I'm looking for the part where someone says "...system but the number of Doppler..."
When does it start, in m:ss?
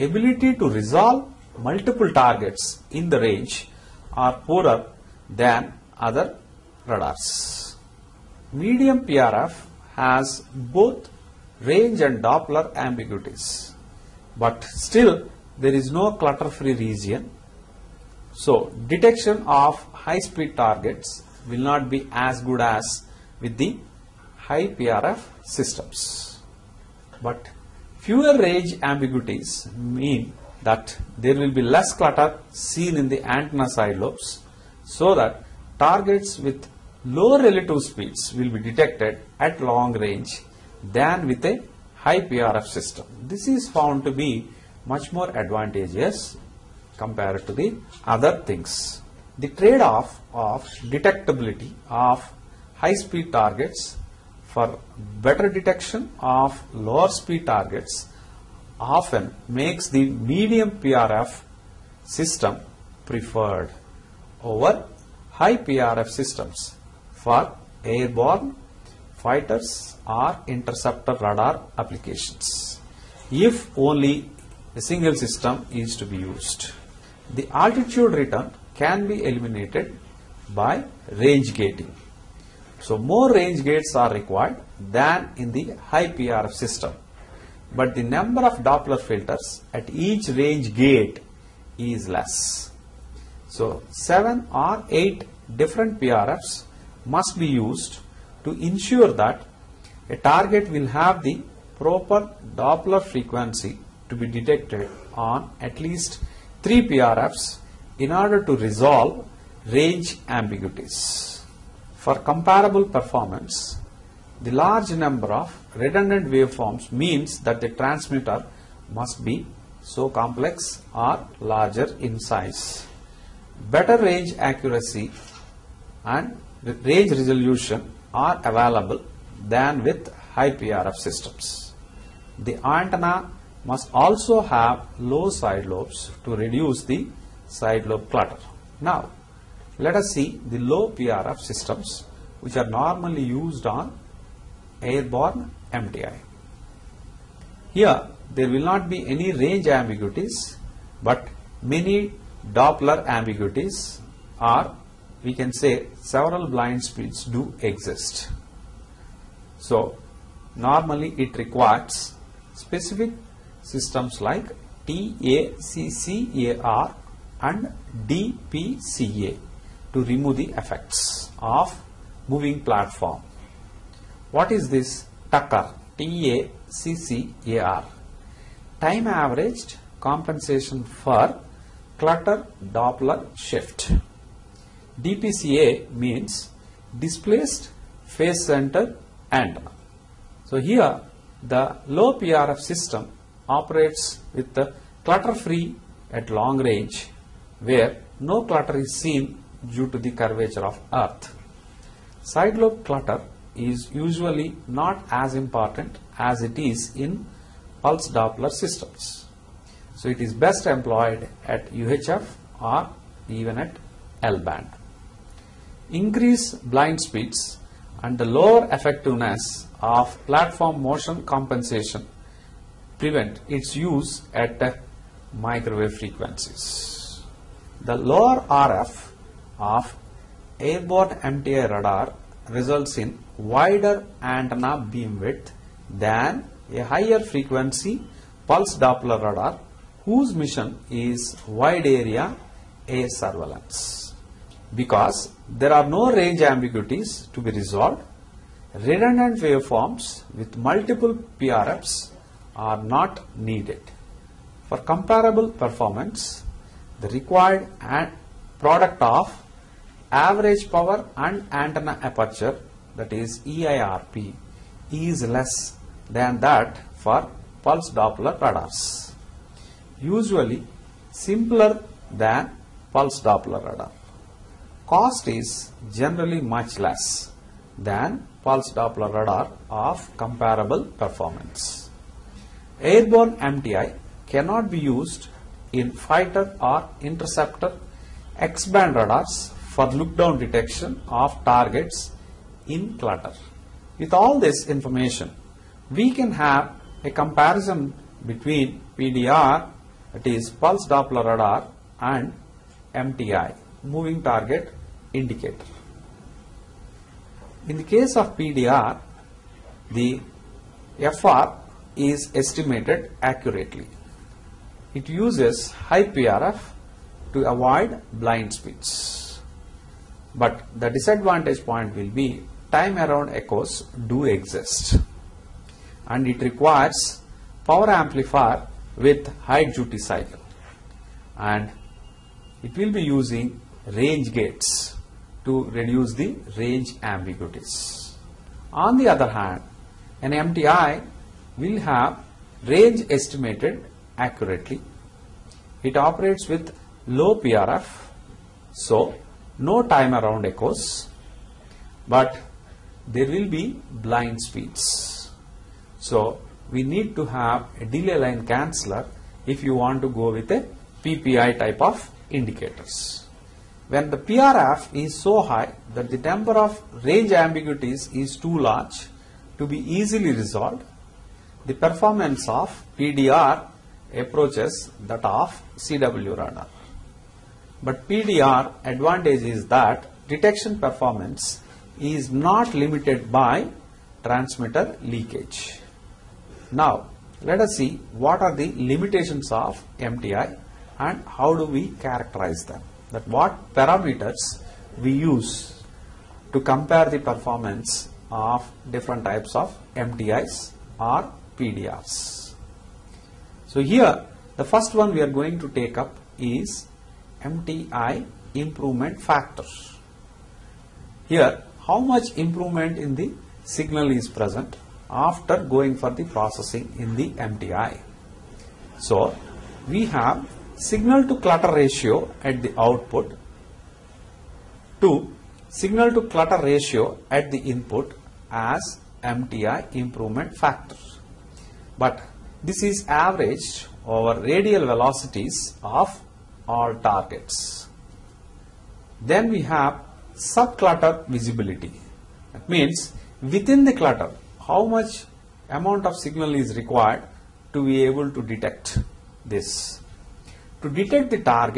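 1:26.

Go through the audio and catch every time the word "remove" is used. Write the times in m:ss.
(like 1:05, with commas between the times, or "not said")
2:50.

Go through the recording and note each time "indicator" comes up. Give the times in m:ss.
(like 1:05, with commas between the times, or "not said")
5:05, 6:02.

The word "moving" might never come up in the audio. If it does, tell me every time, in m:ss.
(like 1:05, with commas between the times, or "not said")
2:52, 5:03.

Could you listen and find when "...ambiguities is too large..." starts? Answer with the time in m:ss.
6:07.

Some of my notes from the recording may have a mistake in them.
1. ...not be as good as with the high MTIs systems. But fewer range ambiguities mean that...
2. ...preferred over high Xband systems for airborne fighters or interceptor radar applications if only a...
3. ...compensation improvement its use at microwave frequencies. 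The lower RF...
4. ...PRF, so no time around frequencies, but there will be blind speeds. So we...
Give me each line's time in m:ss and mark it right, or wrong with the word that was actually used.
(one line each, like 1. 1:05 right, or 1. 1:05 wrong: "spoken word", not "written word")
1. 0:21 wrong: "PRF", not "MTIs"
2. 1:03 wrong: "PRF", not "Xband"
3. 3:41 wrong: "prevent", not "improvement"
4. 5:47 wrong: "echoes", not "frequencies".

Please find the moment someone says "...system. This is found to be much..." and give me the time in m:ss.
0:42.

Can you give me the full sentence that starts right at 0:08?
Medium PRF has both range and Doppler ambiguities but still there is no clutter-free region.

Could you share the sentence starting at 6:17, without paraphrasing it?
But PDR advantage is that detection performance is not limited by transmitter leakage.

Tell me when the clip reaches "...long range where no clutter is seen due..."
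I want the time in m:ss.
3:16.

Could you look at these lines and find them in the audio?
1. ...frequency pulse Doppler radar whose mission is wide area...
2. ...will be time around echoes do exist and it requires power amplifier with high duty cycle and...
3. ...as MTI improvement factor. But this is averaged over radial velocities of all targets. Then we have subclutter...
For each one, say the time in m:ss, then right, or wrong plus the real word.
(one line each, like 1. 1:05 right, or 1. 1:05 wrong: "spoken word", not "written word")
1. 3:57 right
2. 5:21 right
3. 7:08 right.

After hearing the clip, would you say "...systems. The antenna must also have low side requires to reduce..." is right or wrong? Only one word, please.
wrong.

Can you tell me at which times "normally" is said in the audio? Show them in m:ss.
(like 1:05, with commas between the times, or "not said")
2:22, 2:40.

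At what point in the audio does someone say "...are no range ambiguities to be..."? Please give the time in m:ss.
4:05.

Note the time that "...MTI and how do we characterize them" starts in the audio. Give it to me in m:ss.
6:29.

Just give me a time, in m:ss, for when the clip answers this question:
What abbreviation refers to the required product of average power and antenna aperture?
4:23.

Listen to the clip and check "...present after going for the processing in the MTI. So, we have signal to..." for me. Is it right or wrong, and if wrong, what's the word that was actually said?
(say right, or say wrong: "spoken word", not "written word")
right.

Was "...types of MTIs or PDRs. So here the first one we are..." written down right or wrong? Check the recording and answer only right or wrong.
right.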